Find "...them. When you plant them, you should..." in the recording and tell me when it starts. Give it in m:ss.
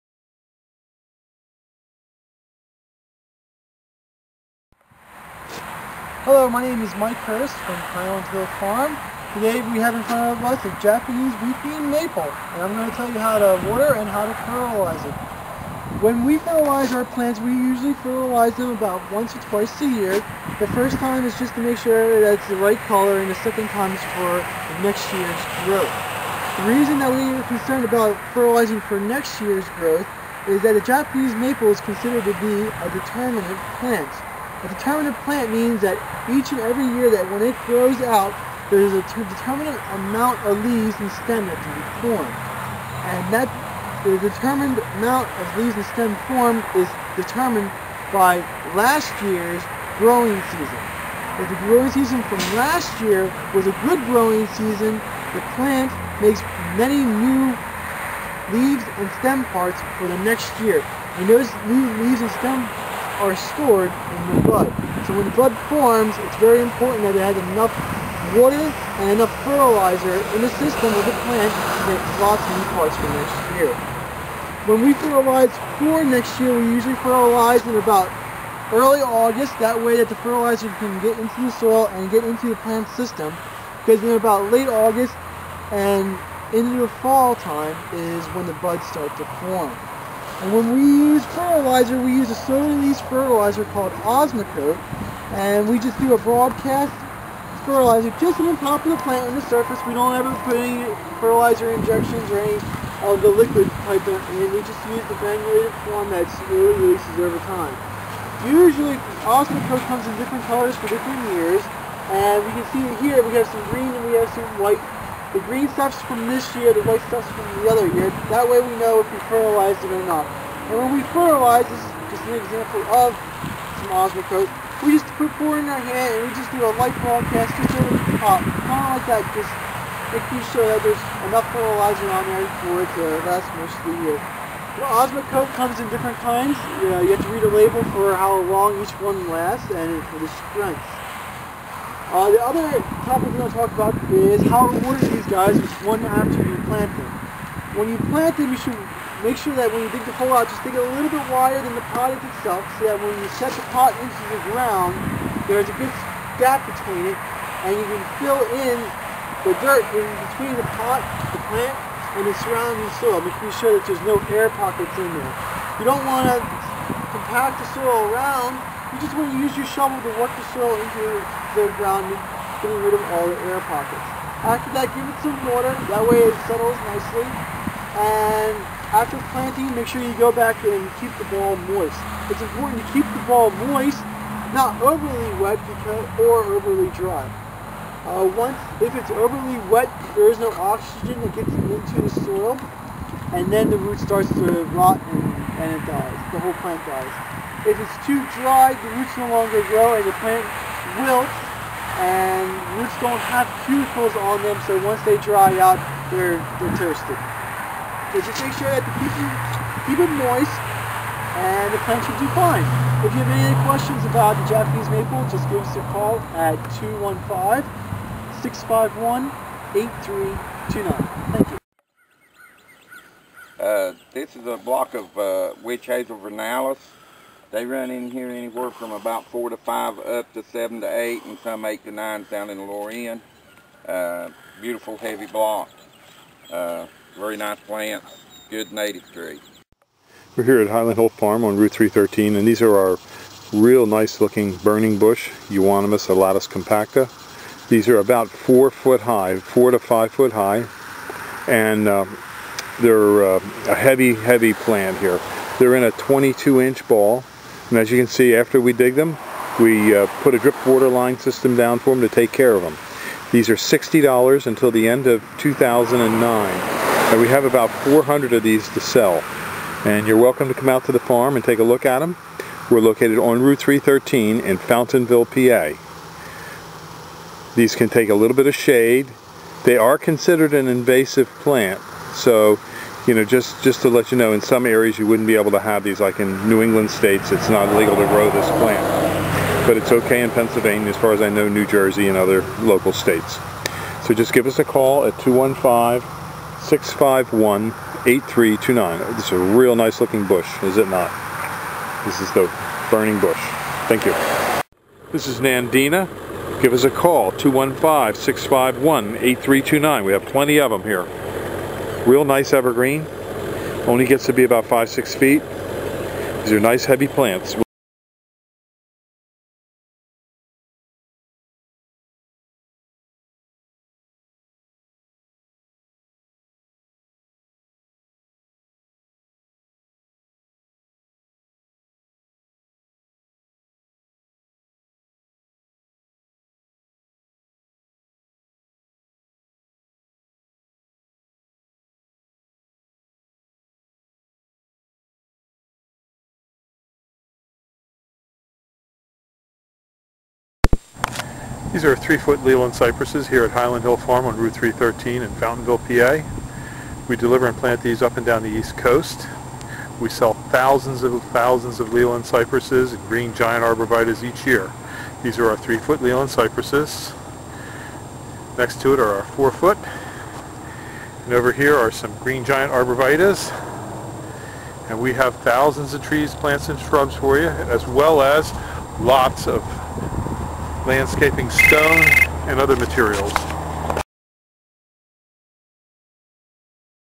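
2:26.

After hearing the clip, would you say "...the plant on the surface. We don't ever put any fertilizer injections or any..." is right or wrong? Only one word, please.
right.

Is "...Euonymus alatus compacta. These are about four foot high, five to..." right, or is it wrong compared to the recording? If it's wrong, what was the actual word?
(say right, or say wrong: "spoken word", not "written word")
wrong: "four", not "five".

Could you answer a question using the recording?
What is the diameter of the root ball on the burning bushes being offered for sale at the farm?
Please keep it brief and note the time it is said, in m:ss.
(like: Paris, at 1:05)
22 inch, at 4:15.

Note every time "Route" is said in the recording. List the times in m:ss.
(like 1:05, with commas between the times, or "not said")
4:01, 4:33, 5:54.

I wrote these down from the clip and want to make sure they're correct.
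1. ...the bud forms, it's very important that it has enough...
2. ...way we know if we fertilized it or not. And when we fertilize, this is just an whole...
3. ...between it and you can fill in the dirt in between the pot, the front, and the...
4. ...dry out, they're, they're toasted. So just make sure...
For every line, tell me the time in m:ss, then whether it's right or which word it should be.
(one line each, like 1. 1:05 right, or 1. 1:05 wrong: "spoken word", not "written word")
1. 1:05 right
2. 1:58 wrong: "example", not "whole"
3. 2:36 wrong: "plant", not "front"
4. 3:25 right.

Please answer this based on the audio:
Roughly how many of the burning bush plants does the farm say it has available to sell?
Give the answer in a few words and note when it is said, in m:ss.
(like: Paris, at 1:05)
400, at 4:27.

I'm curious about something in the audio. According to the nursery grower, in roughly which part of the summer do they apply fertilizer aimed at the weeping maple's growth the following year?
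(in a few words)
early August.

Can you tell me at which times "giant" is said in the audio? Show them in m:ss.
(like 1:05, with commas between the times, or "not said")
6:03, 6:12.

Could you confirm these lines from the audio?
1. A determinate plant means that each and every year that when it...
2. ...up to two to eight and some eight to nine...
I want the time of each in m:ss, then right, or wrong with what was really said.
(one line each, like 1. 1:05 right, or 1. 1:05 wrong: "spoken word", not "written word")
1. 0:34 right
2. 3:49 wrong: "seven", not "two".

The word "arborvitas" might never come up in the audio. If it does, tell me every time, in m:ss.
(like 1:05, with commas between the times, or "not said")
6:03, 6:12.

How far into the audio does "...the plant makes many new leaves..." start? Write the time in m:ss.
0:55.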